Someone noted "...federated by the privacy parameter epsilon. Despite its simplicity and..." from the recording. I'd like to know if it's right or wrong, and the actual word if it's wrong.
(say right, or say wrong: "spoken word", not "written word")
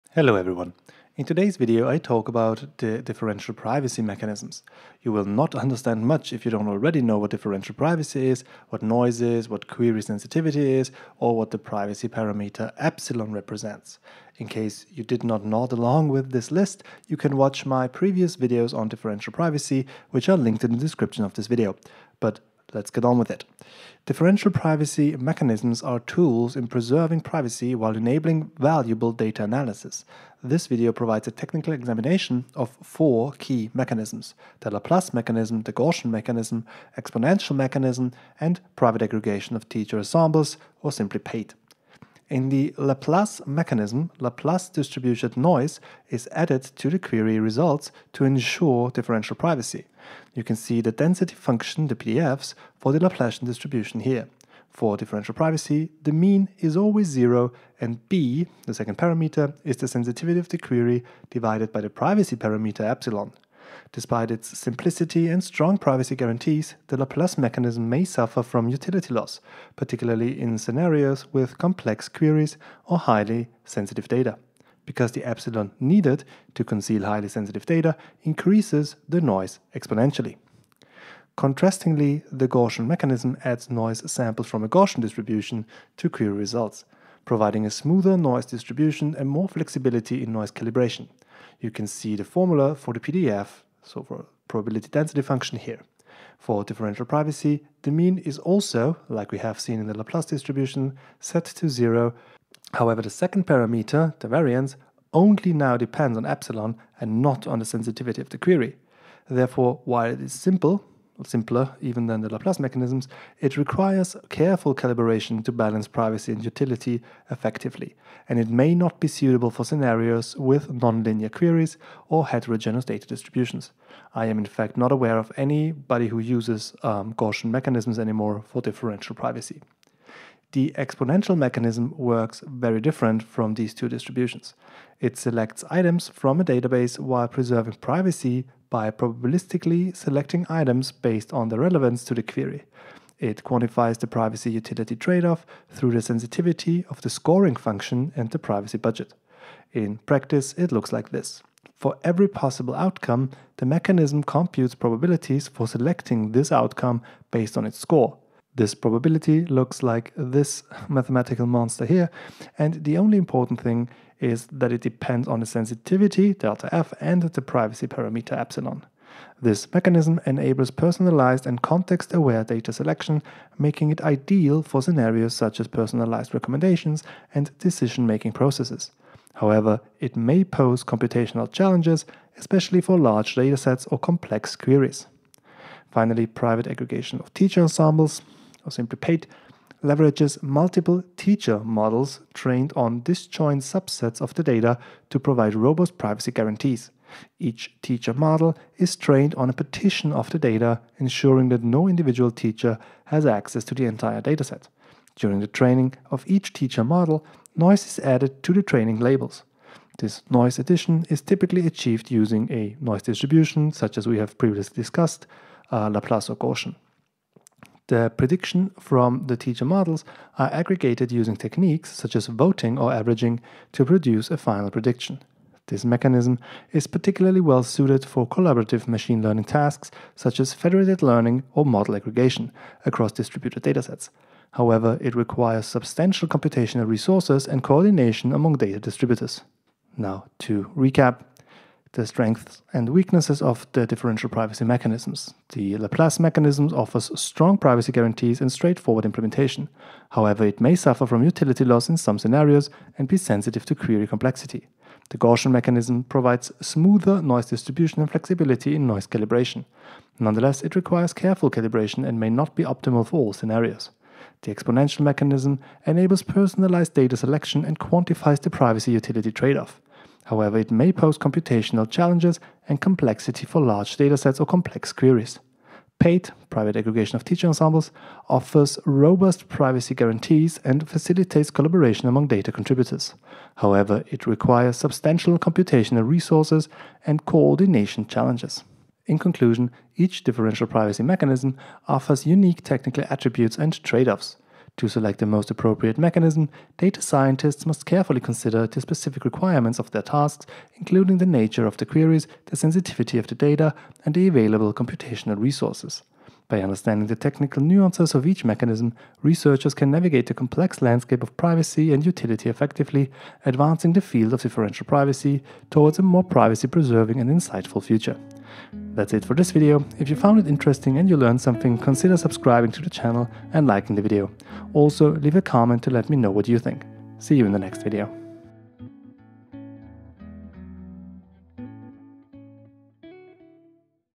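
wrong: "divided", not "federated".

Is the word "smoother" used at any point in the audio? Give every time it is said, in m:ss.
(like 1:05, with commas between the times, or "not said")
1:27, 4:16.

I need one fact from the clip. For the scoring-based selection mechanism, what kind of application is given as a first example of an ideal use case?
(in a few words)
personalized recommendations.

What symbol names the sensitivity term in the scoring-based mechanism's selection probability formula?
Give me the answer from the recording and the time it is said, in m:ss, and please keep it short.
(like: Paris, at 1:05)
delta F, at 2:46.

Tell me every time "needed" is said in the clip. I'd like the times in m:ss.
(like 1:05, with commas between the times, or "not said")
1:15.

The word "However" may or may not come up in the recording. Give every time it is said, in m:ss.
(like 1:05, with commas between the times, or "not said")
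1:42, 2:59, 3:54, 4:10, 4:30, 4:43.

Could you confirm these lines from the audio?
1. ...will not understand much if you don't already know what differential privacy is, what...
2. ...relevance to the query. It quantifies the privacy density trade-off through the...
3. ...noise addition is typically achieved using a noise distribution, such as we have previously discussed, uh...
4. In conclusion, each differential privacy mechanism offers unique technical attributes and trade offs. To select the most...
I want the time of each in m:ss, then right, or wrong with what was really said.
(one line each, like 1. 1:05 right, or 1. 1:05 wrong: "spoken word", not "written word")
1. 0:05 right
2. 2:21 wrong: "utility", not "density"
3. 3:30 right
4. 4:49 right.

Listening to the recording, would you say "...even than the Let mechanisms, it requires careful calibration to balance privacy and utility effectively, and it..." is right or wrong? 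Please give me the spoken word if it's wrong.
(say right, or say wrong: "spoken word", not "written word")
wrong: "Laplace", not "Let".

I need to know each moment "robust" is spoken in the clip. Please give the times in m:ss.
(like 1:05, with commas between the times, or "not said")
3:15, 4:38.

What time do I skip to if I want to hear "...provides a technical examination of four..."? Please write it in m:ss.
0:30.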